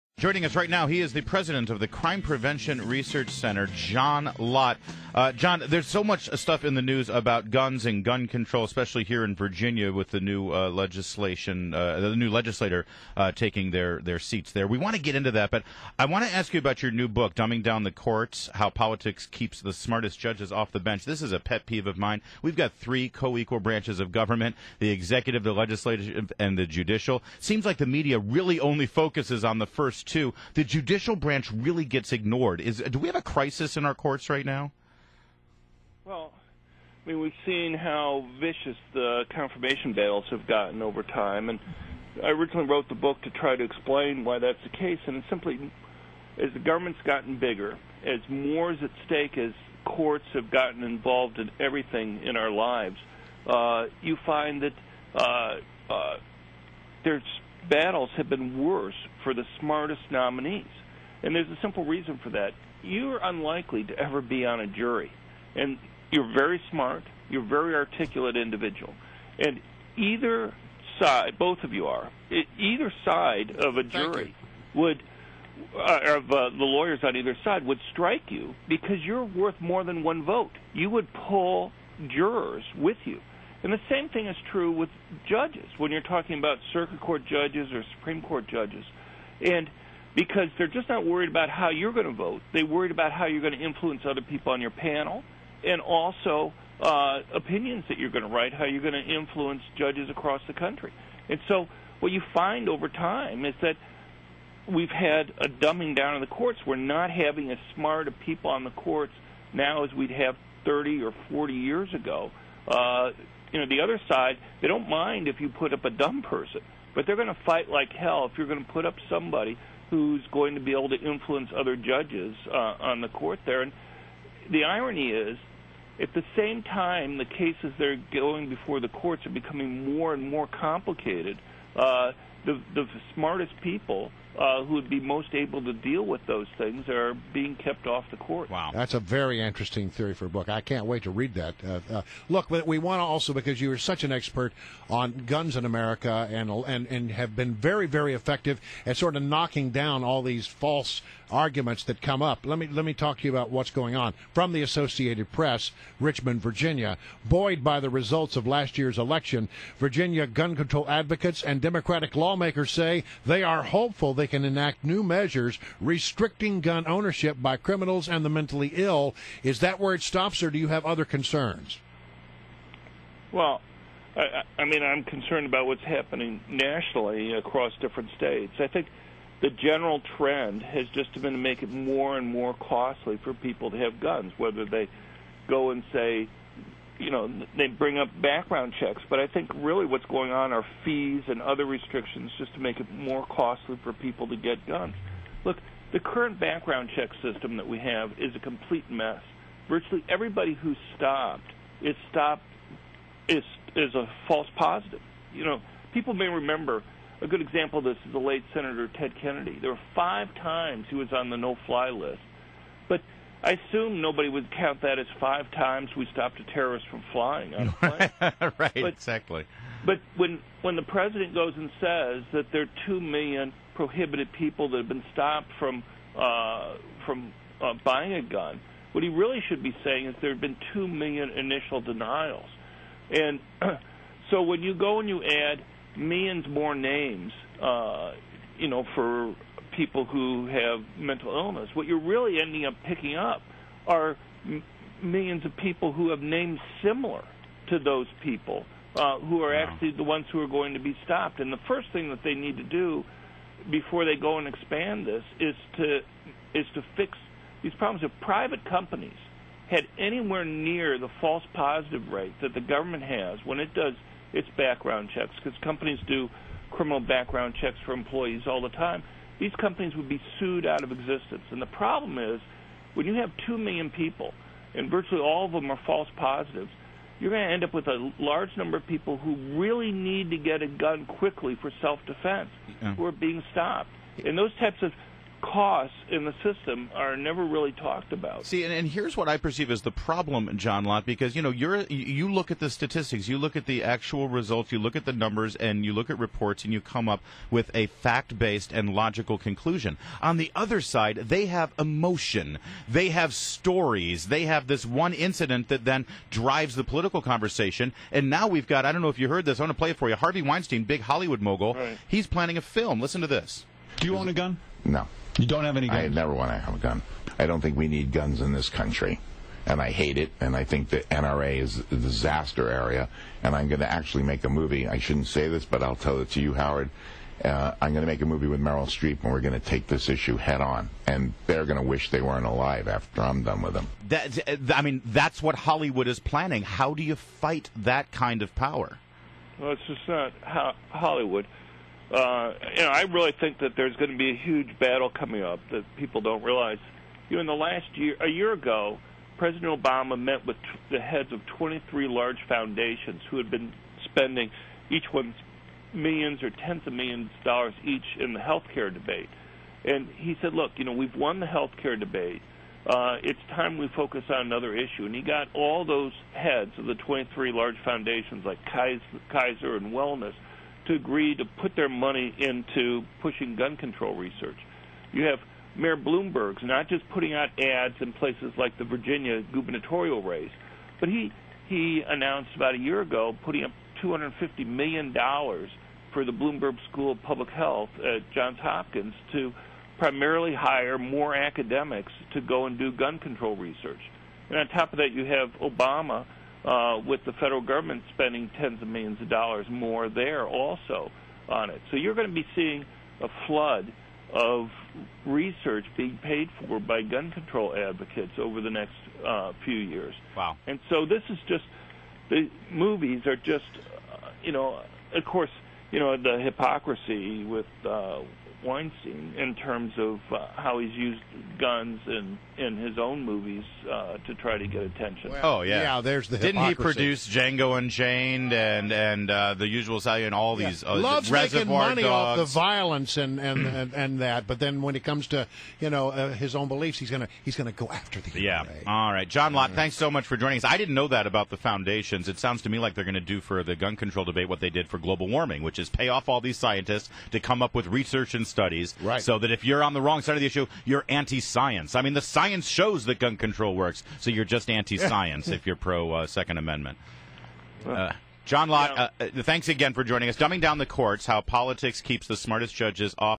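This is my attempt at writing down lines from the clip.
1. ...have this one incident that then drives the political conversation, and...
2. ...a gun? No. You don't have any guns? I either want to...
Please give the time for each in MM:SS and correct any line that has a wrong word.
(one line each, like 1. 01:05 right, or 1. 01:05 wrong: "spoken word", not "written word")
1. 05:04 right
2. 05:14 wrong: "never", not "either".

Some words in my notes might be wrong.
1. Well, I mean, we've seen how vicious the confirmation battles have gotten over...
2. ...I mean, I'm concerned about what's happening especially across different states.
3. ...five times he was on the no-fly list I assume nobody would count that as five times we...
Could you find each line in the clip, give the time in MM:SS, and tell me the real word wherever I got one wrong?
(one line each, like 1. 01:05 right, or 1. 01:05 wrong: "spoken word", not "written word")
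1. 00:36 right
2. 02:54 wrong: "nationally", not "especially"
3. 03:29 right.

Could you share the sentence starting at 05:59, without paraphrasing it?
And he said, "Look, you know, we've won the health care debate.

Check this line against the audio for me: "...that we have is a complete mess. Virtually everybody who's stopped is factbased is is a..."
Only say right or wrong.
wrong.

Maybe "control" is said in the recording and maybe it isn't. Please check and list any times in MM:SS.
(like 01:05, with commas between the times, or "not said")
00:08, 02:40, 06:13, 06:33, 06:47, 07:23, 07:33.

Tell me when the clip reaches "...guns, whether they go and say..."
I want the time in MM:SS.
03:03.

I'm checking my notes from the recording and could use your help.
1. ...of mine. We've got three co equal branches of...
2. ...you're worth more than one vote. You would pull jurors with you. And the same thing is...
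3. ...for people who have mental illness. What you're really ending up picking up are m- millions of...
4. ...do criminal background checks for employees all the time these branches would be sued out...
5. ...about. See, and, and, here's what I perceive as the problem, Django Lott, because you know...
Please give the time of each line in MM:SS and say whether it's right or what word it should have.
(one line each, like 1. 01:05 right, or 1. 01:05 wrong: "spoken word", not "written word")
1. 00:21 right
2. 01:19 right
3. 03:58 right
4. 04:26 wrong: "companies", not "branches"
5. 04:48 wrong: "John", not "Django".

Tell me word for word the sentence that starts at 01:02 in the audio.
You're unlikely to ever be on a jury.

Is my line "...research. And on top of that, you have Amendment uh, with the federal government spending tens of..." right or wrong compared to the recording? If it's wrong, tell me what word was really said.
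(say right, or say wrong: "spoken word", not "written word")
wrong: "Obama", not "Amendment".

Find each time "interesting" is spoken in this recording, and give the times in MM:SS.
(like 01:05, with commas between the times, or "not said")
02:19.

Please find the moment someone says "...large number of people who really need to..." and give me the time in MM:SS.
04:38.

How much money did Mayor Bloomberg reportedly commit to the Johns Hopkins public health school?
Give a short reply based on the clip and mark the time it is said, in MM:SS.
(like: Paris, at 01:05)
250 million dollars, at 06:24.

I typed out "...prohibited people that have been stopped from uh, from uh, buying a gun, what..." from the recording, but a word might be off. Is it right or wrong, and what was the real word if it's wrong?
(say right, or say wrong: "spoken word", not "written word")
right.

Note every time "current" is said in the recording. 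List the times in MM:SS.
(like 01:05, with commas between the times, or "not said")
03:15.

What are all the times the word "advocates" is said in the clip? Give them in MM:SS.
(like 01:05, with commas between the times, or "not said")
02:40, 06:47.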